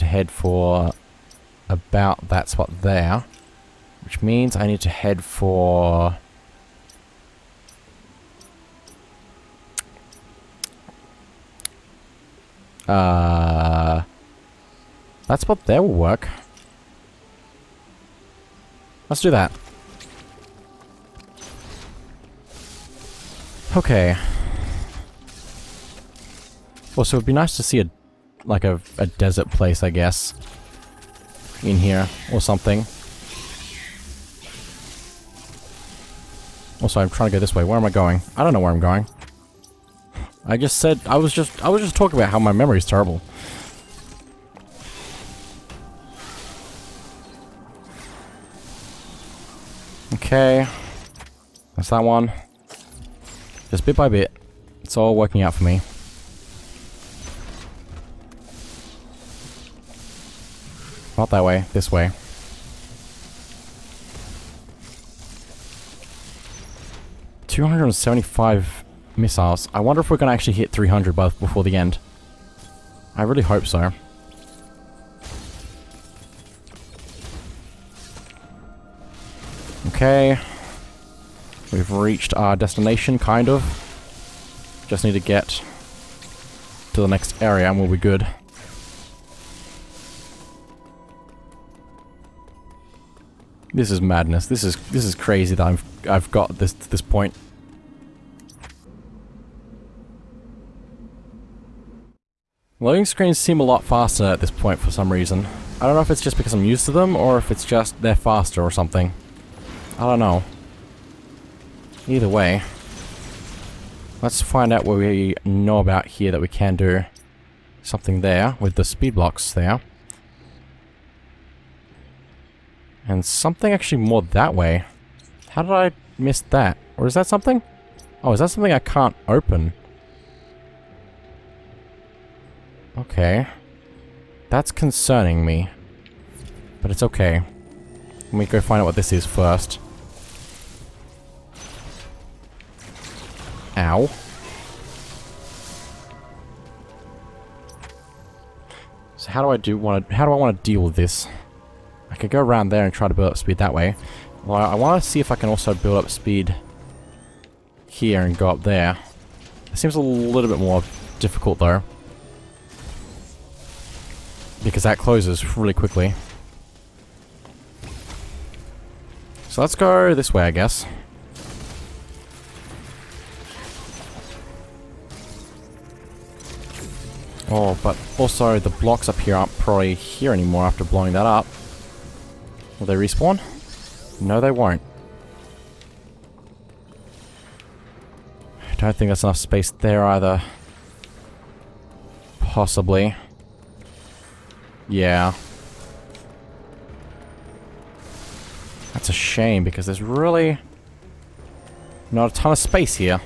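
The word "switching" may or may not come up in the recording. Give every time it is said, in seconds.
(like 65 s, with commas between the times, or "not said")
not said.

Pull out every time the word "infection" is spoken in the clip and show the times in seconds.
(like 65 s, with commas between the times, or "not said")
not said.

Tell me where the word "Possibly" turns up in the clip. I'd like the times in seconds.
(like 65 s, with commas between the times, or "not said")
192 s.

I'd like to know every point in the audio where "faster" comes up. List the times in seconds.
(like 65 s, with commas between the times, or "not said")
103 s, 108 s.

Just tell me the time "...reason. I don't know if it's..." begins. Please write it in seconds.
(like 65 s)
105 s.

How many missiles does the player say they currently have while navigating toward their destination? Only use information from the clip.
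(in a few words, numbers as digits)
275.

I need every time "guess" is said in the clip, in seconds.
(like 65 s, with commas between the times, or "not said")
29 s, 170 s.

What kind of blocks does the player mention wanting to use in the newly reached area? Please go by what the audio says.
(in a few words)
Speed blocks.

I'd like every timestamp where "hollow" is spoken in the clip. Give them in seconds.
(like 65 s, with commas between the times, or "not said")
not said.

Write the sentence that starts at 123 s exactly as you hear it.
And something actually more that way.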